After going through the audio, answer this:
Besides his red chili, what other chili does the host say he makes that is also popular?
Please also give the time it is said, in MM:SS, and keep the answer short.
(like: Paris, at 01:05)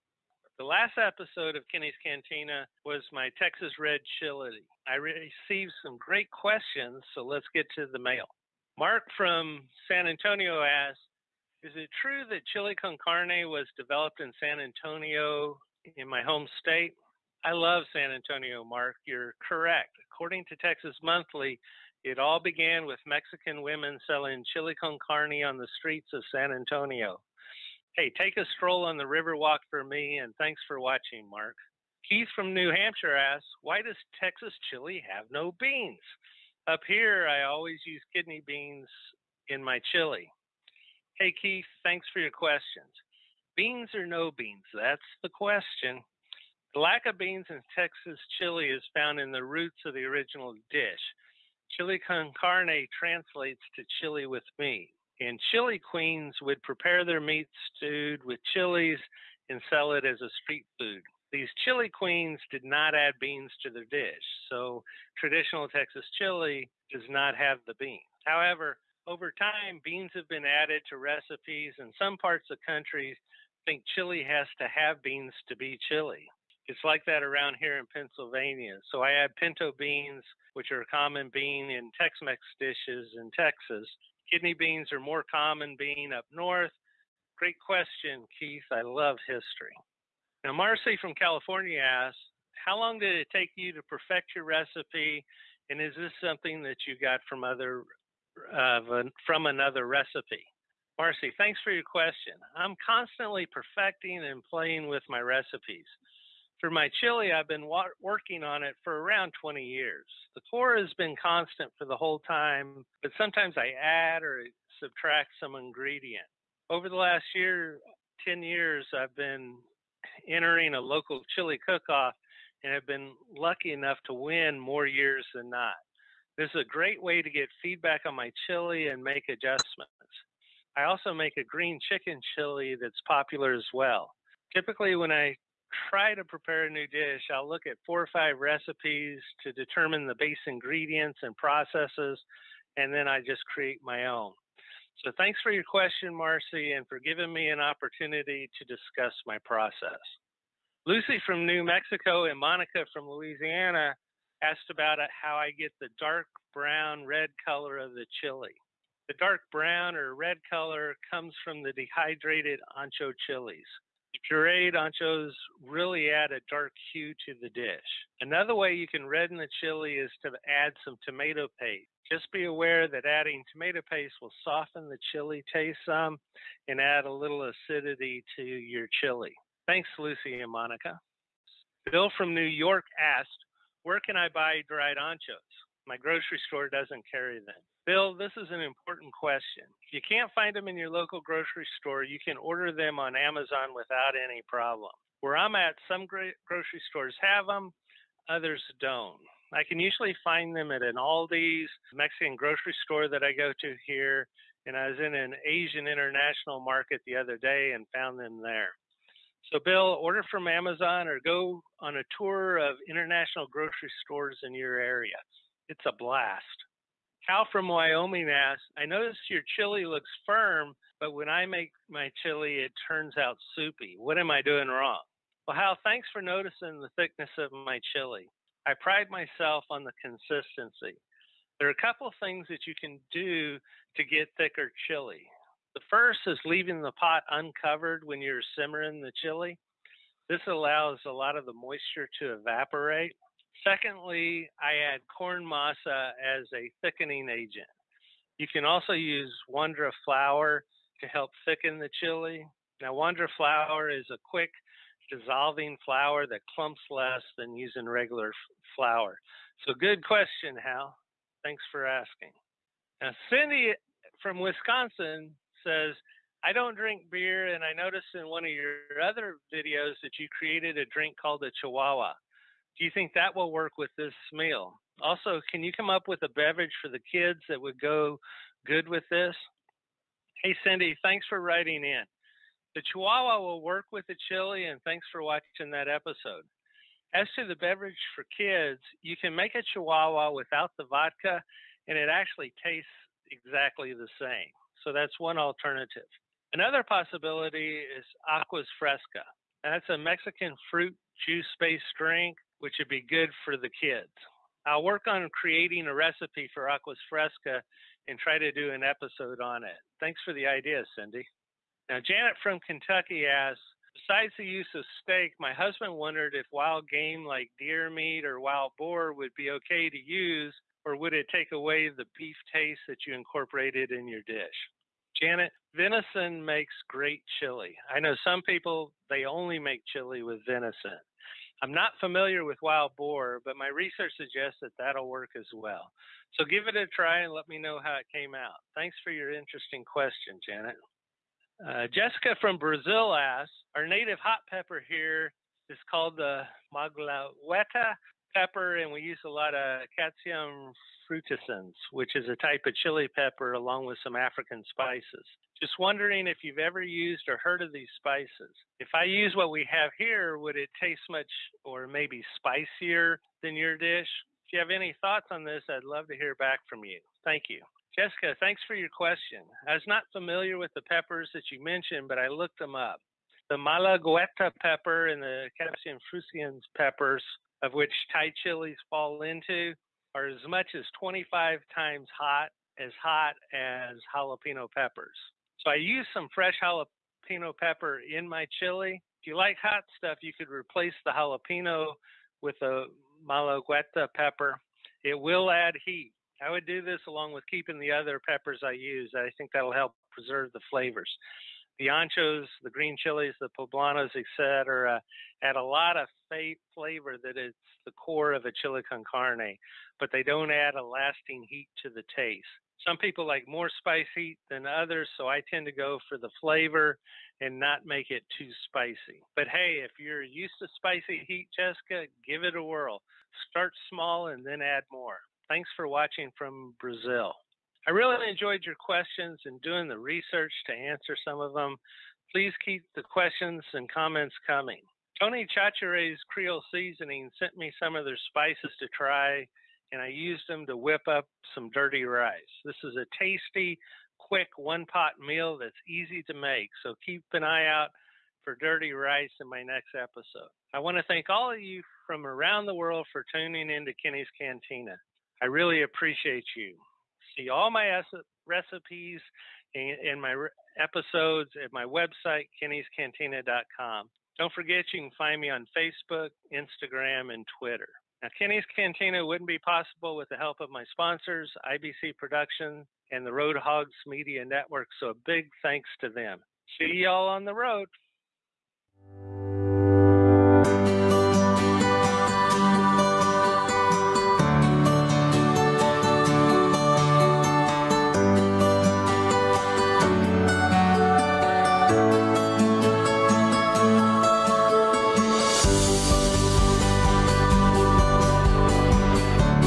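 Green chicken chili, at 02:11.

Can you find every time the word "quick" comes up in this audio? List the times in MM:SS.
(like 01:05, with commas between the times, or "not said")
04:14, 07:24.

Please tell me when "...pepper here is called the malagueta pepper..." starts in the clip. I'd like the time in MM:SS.
05:44.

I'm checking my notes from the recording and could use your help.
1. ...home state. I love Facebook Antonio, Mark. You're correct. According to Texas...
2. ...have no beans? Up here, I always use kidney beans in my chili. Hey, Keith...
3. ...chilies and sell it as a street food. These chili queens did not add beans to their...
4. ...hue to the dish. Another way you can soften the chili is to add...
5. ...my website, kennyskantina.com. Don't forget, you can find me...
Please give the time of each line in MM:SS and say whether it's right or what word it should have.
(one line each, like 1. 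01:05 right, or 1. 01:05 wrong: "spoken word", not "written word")
1. 00:16 wrong: "San", not "Facebook"
2. 00:35 right
3. 00:58 right
4. 02:46 wrong: "redden", not "soften"
5. 07:41 right.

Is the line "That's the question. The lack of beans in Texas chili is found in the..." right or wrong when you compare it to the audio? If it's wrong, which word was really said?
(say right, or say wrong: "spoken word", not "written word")
right.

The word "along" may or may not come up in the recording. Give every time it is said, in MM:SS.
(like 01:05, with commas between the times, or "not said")
05:53, 06:37.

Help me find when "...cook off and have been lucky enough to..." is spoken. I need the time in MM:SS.
02:01.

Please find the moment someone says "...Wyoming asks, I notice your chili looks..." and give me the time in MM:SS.
03:37.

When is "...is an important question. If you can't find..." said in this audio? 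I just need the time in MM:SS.
03:08.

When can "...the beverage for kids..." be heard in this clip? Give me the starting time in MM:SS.
04:47.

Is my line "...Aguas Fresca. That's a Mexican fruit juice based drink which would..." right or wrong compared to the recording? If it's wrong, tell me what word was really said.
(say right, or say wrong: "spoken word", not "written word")
right.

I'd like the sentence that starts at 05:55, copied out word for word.
Just wondering if you've ever used or heard of these spices.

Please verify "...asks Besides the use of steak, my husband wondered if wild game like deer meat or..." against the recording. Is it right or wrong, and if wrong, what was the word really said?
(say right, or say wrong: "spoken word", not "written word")
right.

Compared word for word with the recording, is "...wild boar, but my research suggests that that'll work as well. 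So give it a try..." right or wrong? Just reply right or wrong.
right.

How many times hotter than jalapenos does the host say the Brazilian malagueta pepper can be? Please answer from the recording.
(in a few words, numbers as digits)
25.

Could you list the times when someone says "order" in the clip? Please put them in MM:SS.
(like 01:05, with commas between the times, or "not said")
03:12, 03:29.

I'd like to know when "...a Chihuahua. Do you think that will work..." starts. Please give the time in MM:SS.
04:31.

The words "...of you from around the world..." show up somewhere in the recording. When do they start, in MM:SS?
07:31.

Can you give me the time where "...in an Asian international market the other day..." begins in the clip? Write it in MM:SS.
03:24.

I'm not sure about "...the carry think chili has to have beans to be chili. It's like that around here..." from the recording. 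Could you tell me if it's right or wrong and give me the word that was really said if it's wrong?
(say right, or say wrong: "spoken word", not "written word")
wrong: "country", not "carry".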